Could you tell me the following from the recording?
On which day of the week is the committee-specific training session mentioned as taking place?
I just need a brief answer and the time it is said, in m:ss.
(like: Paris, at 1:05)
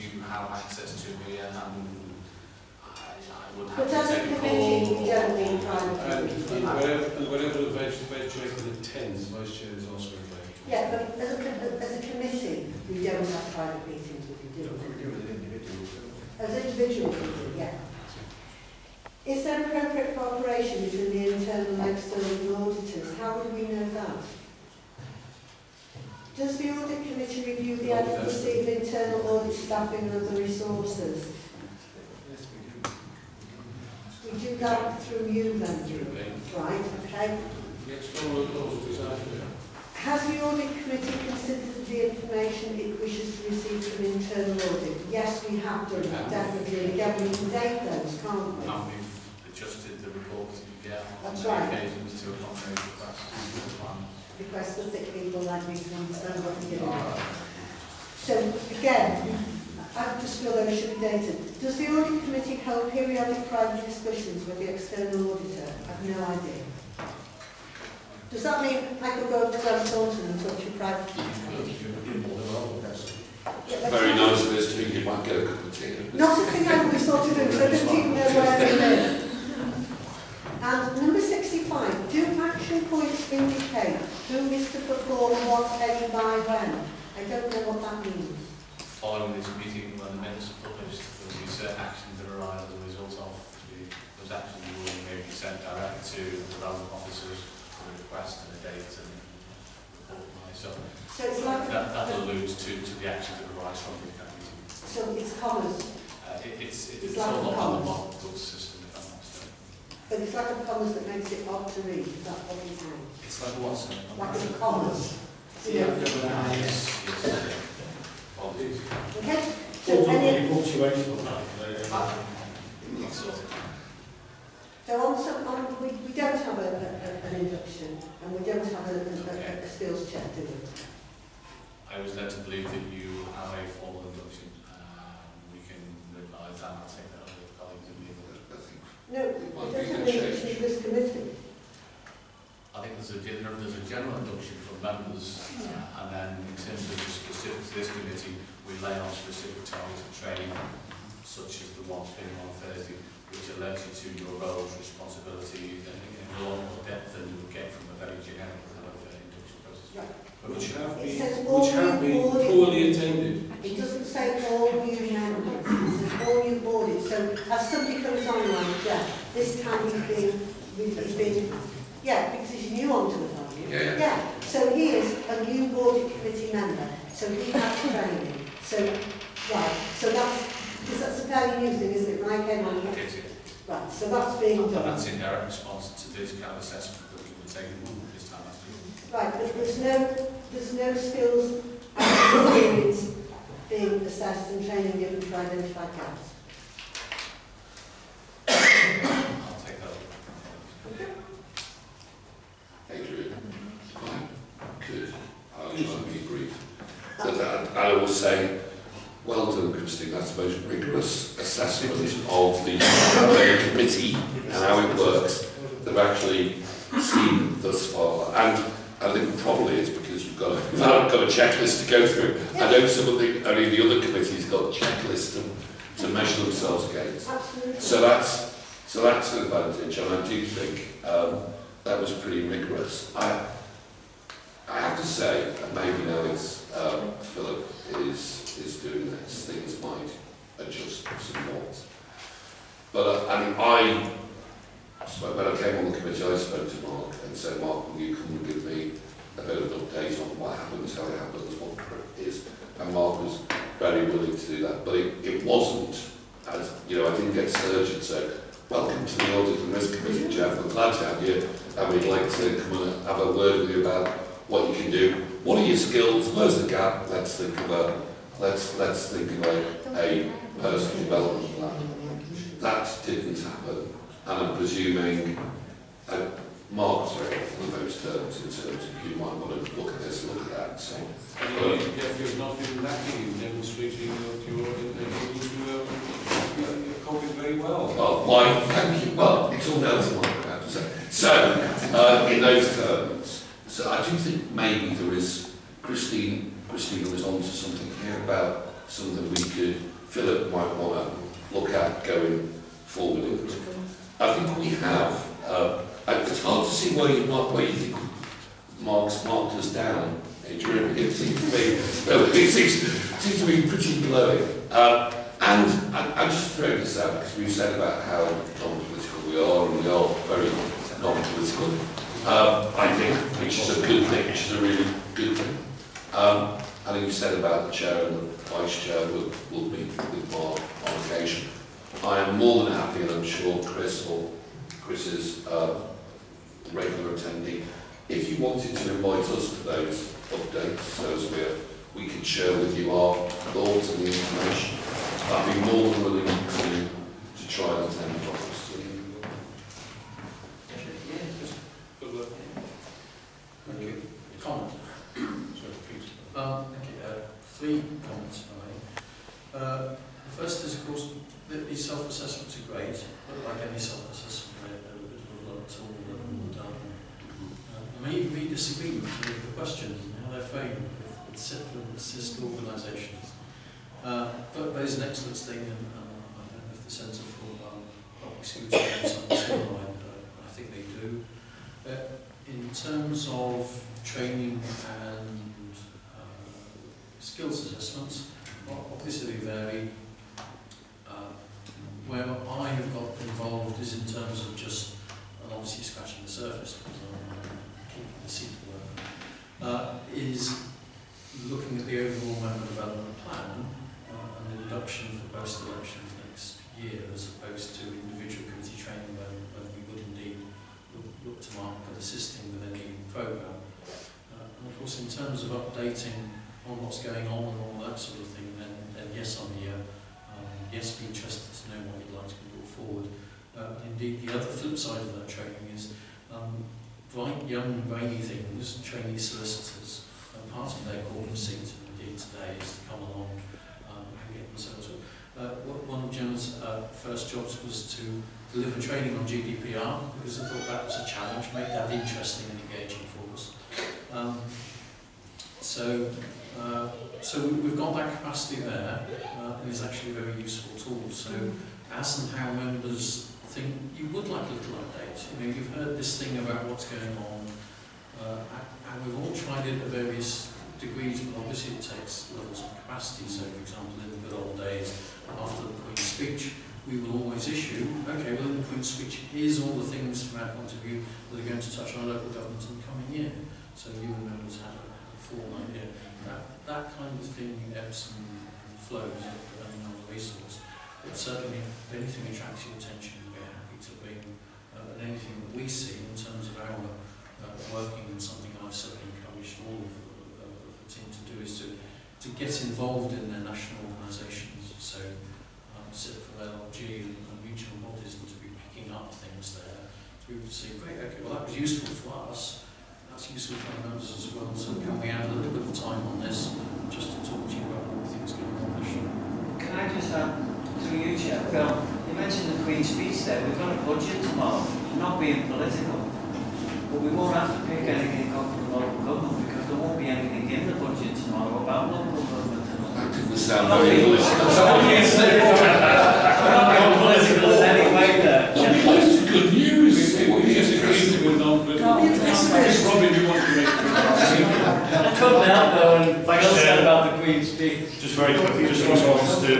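Thursday, at 2:32.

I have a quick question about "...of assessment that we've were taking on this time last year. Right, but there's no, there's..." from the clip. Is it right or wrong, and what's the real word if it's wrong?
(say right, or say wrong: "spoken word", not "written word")
right.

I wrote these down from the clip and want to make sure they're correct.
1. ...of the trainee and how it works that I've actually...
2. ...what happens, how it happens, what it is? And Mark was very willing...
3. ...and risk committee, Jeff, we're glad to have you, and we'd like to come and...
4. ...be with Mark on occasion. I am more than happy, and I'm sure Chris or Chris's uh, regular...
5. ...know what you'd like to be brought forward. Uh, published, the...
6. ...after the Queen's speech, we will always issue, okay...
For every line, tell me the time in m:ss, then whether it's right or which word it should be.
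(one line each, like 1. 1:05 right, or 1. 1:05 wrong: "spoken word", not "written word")
1. 3:32 wrong: "committee", not "trainee"
2. 4:10 right
3. 4:19 right
4. 5:29 right
5. 7:01 wrong: "indeed", not "published"
6. 7:45 right.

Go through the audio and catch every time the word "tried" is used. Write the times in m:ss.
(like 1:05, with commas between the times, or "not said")
7:39.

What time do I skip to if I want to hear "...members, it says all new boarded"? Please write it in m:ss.
2:45.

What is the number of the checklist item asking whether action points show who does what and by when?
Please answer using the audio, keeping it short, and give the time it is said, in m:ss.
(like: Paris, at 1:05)
65, at 1:21.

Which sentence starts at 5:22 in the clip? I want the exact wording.
Uh, I think, which is a good thing, which is a really good thing.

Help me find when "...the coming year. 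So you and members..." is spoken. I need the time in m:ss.
7:52.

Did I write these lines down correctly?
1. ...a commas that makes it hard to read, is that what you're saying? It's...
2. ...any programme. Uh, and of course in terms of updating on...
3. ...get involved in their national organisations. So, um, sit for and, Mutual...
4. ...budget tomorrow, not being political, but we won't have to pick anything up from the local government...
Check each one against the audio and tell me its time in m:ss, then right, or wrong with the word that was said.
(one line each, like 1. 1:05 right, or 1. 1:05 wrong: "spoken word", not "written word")
1. 1:50 right
2. 6:52 right
3. 8:12 right
4. 8:33 right.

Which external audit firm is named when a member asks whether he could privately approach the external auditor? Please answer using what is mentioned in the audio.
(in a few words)
Grant Thornton.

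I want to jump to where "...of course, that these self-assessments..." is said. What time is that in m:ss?
6:00.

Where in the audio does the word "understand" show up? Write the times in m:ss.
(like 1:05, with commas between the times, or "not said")
0:55.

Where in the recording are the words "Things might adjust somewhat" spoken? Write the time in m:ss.
3:59.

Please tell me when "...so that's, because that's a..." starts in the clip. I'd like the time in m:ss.
2:59.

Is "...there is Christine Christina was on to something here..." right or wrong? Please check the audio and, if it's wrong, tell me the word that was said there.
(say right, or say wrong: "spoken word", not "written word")
right.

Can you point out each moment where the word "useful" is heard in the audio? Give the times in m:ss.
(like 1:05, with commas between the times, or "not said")
7:30, 8:21.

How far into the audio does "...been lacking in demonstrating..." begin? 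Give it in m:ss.
4:42.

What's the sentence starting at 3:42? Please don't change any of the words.
I know some of the, only the other committees got checklists to, to measure themselves against.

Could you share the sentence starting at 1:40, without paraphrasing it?
So, so it's like that, that alludes to, to the actions that arise from the meeting.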